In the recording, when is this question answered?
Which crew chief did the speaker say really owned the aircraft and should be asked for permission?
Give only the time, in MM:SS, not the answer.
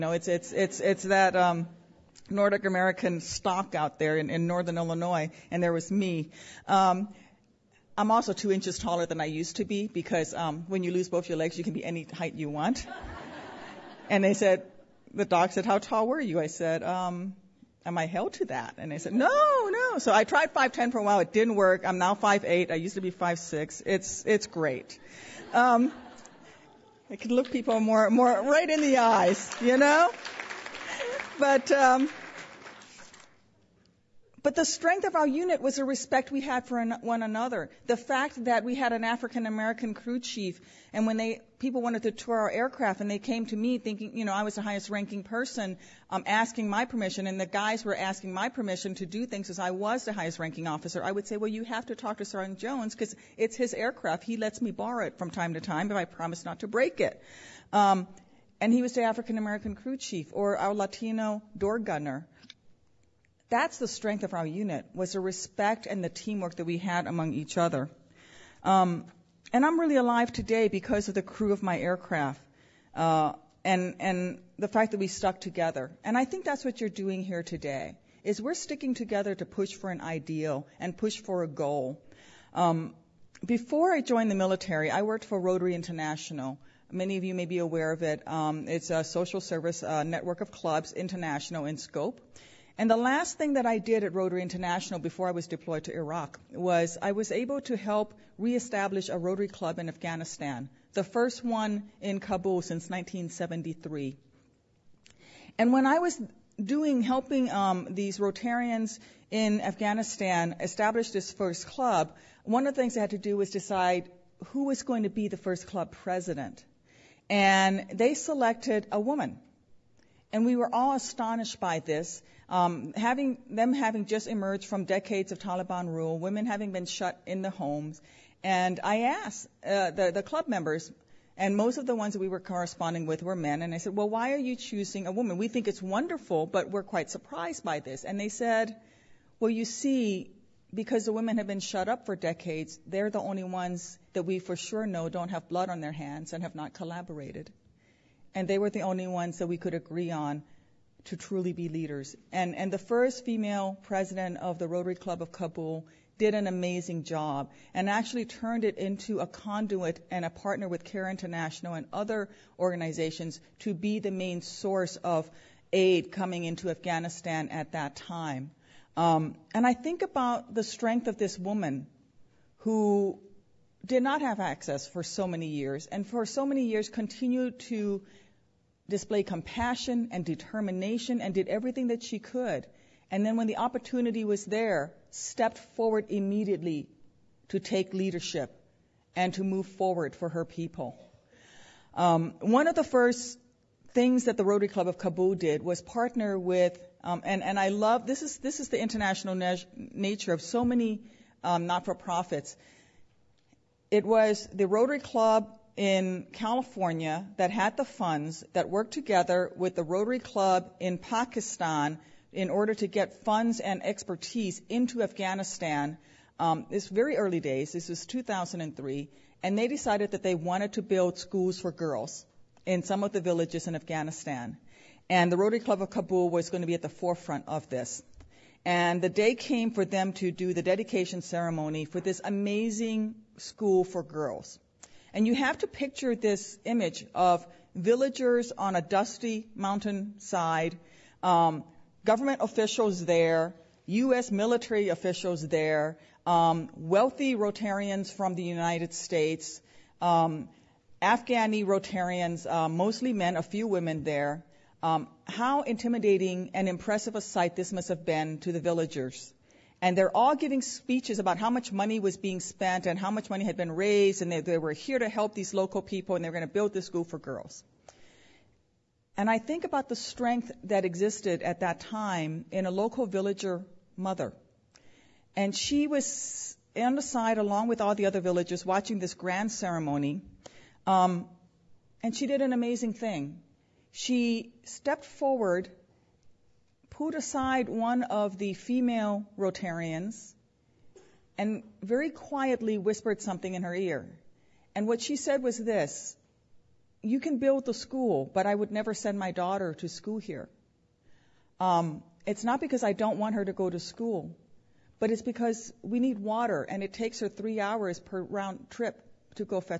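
00:52.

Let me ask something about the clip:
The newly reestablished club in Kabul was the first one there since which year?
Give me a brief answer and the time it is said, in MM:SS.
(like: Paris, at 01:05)
1973, at 01:42.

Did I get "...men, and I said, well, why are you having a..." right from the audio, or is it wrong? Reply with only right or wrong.
wrong.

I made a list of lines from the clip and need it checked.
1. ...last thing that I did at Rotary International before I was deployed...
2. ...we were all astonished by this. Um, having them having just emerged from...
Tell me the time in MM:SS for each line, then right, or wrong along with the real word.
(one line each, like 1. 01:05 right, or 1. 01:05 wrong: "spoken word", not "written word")
1. 01:32 right
2. 02:00 right.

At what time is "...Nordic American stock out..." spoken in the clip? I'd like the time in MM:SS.
00:02.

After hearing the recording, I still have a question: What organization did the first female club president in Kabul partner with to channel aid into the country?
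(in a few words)
Care International.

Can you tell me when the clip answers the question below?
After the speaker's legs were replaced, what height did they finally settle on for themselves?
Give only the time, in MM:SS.
00:22.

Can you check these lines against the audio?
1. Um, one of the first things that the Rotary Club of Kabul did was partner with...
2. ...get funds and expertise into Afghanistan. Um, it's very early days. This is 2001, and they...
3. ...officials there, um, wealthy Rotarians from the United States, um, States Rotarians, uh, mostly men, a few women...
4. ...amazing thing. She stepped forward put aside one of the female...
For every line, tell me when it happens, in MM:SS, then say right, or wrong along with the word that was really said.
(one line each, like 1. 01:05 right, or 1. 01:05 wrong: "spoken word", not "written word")
1. 03:11 right
2. 03:32 wrong: "2003", not "2001"
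3. 04:04 wrong: "Afghani", not "States"
4. 04:42 right.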